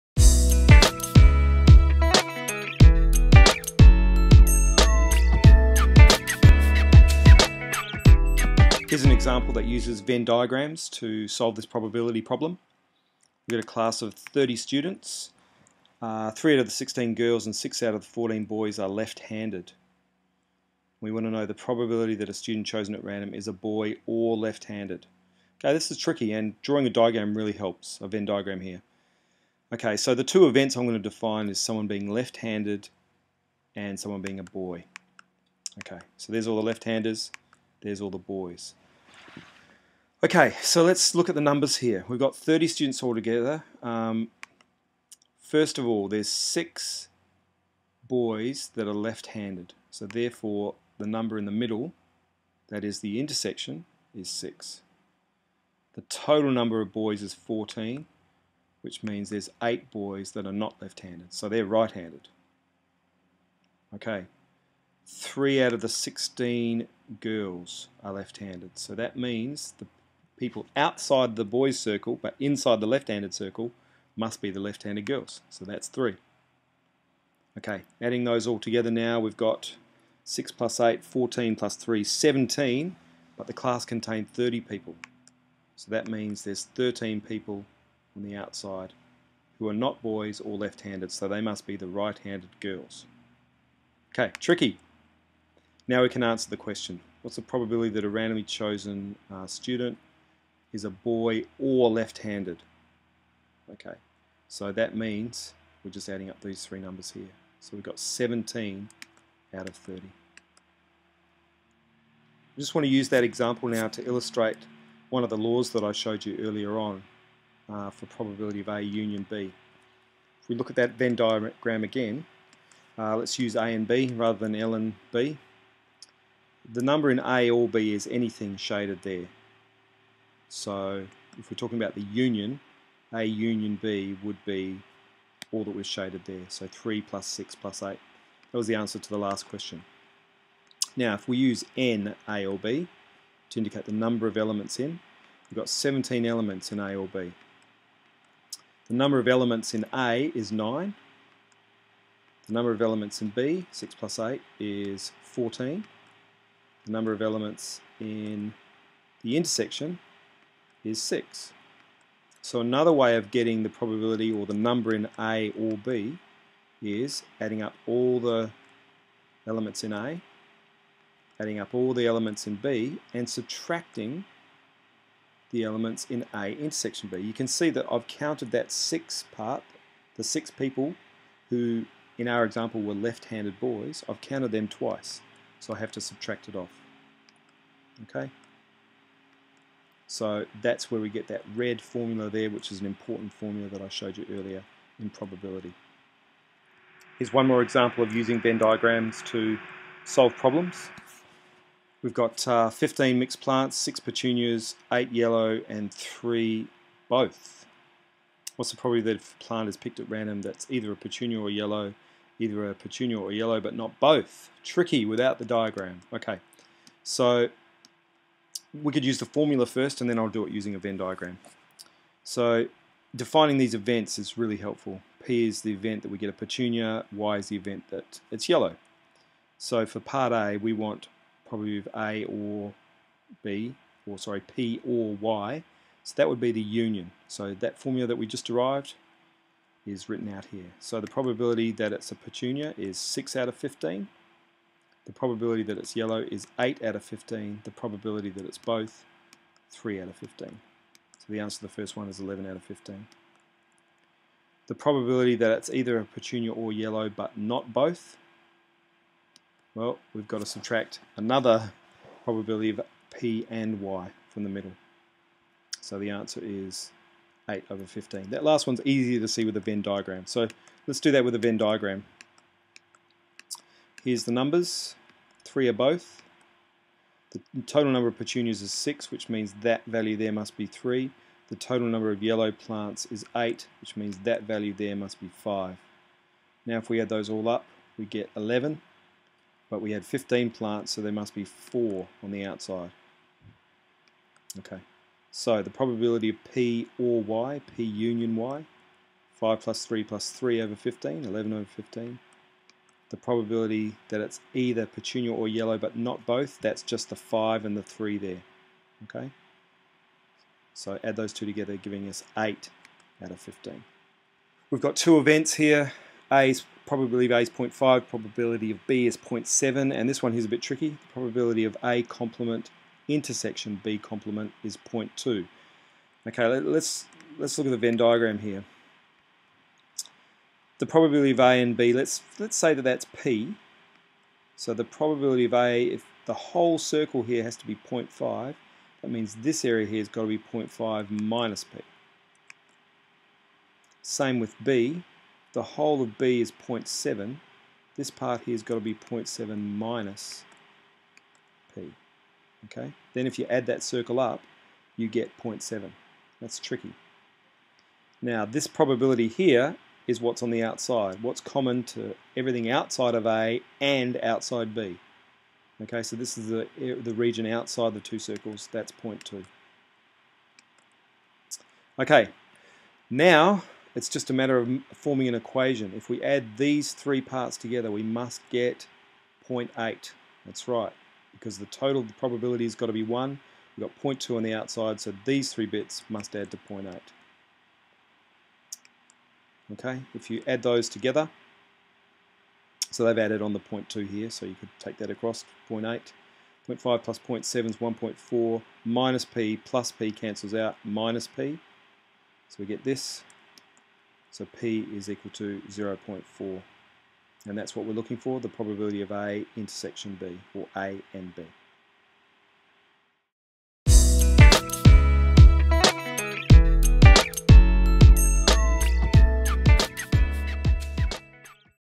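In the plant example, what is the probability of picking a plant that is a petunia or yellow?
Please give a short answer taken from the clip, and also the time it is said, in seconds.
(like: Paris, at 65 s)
11 out of 15, at 251 s.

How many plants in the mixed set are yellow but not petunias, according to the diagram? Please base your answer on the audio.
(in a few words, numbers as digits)
5.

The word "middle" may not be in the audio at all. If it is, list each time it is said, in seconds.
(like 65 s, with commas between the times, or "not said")
51 s, 264 s.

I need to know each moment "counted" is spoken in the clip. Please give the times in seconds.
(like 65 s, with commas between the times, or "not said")
178 s, 184 s.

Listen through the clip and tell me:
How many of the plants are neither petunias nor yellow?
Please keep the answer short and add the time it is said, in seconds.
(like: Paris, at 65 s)
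4, at 291 s.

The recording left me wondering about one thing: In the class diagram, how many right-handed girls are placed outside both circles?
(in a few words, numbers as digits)
13.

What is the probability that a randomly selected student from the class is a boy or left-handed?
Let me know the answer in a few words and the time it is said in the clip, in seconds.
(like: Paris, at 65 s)
17 out of 30, at 107 s.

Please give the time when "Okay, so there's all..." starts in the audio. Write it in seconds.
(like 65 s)
35 s.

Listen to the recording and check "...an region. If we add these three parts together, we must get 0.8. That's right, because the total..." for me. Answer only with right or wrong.
wrong.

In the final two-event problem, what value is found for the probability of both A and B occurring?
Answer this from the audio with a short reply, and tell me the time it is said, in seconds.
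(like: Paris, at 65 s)
0.4, at 404 s.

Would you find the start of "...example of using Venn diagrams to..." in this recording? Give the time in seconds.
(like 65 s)
197 s.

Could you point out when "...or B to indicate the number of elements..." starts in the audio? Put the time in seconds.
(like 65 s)
142 s.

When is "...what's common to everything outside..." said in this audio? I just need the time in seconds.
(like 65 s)
361 s.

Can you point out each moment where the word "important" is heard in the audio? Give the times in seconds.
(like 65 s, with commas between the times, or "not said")
192 s.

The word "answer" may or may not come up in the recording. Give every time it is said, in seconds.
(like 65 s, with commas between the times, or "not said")
96 s, 138 s, 251 s, 266 s.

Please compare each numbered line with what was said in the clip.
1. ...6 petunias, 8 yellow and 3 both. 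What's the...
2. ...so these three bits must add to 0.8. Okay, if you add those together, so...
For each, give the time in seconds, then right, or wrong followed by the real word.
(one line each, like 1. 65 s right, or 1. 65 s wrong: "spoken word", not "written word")
1. 203 s right
2. 384 s right.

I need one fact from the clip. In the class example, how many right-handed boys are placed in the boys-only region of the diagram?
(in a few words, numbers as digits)
8.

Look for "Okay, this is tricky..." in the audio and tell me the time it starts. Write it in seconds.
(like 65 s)
25 s.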